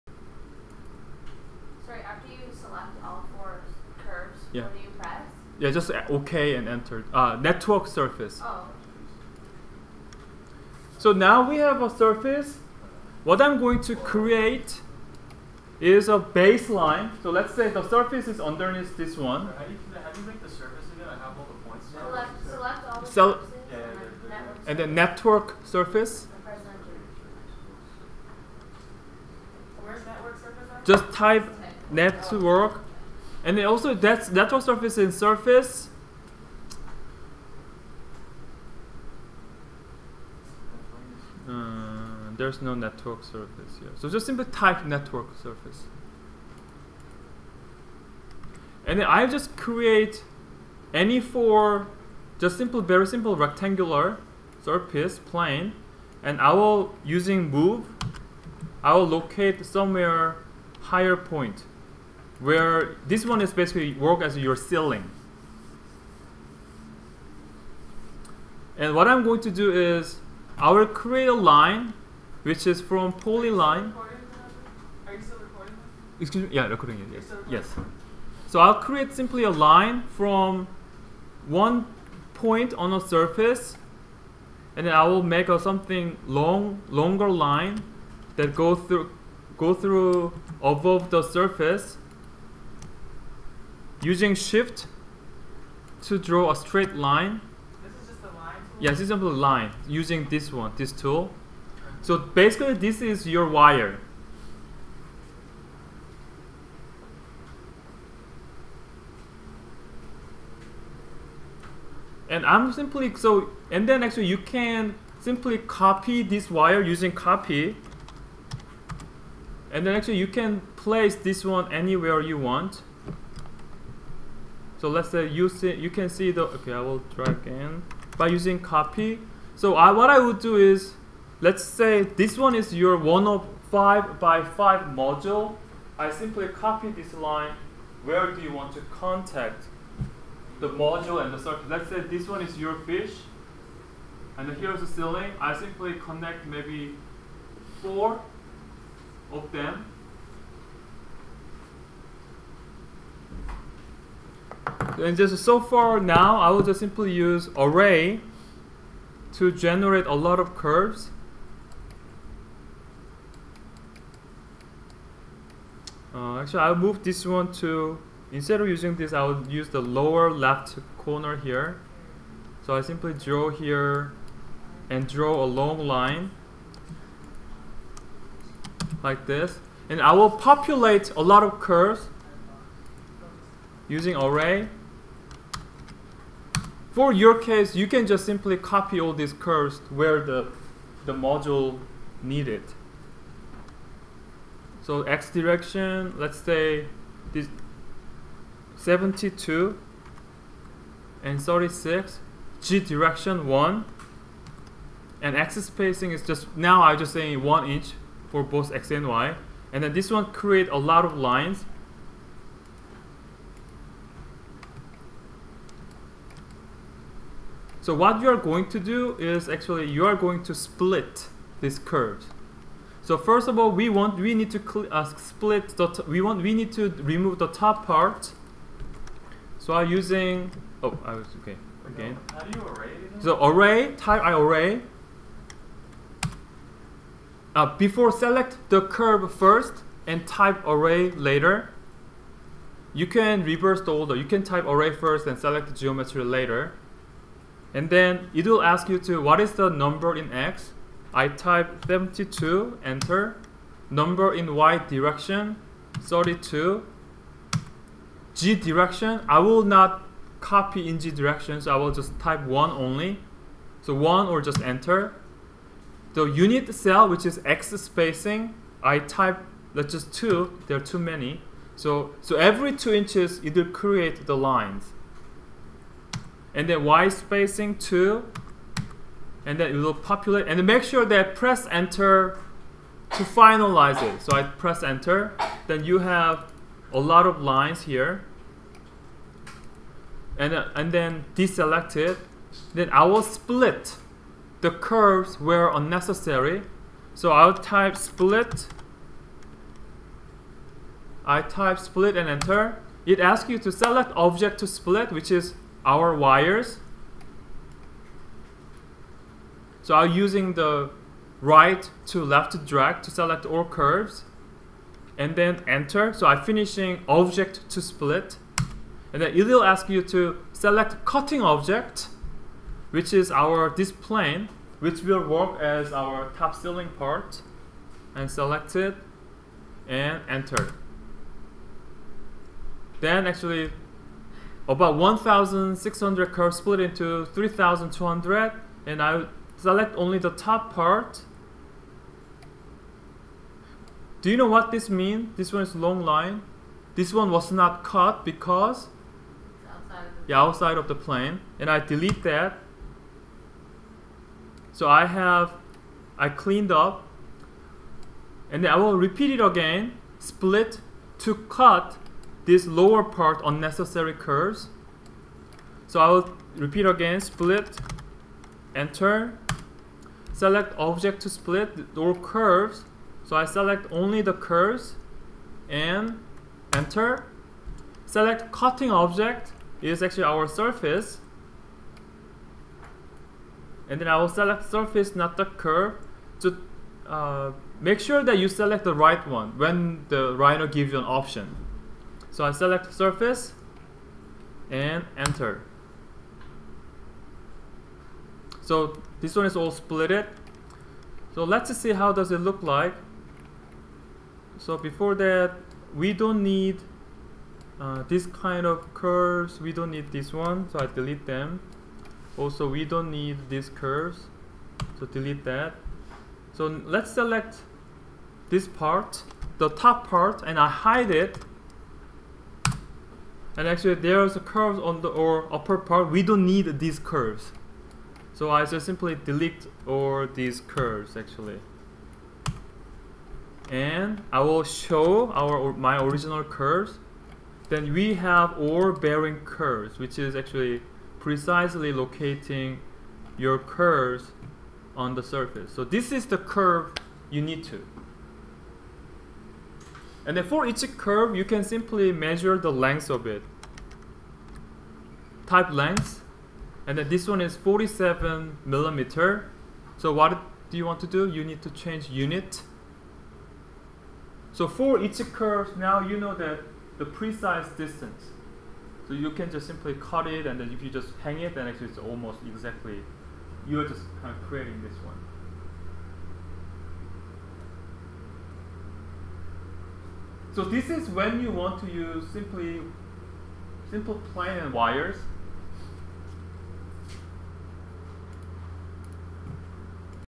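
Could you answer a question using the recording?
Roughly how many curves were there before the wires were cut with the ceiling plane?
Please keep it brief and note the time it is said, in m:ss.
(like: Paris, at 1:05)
1,600, at 5:34.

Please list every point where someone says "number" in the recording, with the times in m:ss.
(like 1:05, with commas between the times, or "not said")
4:09, 4:13.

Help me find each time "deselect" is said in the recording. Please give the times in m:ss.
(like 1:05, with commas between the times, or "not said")
4:51.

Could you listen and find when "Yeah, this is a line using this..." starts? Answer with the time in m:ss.
1:38.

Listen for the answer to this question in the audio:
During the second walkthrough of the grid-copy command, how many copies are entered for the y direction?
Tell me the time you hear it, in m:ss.
4:15.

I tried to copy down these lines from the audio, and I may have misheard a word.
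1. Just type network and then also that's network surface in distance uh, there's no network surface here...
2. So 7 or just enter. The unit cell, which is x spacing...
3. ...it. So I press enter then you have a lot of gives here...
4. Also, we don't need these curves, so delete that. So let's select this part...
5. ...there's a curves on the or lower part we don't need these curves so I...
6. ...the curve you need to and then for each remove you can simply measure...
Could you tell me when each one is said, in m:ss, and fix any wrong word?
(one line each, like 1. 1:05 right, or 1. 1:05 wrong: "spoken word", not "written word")
1. 0:30 wrong: "surface", not "distance"
2. 4:23 wrong: "1", not "7"
3. 4:44 wrong: "lines", not "gives"
4. 6:52 right
5. 7:03 wrong: "upper", not "lower"
6. 7:26 wrong: "curve", not "remove".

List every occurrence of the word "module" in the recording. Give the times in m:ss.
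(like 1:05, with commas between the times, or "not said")
2:14, 2:20, 3:11.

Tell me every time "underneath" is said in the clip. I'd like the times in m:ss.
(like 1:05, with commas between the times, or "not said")
0:18.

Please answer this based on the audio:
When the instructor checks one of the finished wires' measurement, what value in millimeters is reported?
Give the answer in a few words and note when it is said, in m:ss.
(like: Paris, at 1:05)
47 millimeters, at 7:37.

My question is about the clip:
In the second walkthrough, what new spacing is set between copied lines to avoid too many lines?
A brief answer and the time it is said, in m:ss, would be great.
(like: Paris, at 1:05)
2 inches, at 4:32.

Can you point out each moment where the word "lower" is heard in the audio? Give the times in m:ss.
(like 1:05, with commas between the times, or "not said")
2:49, 6:02.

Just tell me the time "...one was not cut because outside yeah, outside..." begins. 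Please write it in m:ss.
5:47.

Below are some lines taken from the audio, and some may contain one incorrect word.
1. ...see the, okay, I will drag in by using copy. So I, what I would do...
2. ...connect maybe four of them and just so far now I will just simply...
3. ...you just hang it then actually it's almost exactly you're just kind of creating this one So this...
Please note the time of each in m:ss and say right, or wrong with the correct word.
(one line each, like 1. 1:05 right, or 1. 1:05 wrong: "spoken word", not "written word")
1. 2:06 right
2. 2:26 right
3. 7:50 right.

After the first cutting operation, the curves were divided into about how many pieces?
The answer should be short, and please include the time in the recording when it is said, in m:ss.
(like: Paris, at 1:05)
3,200, at 5:37.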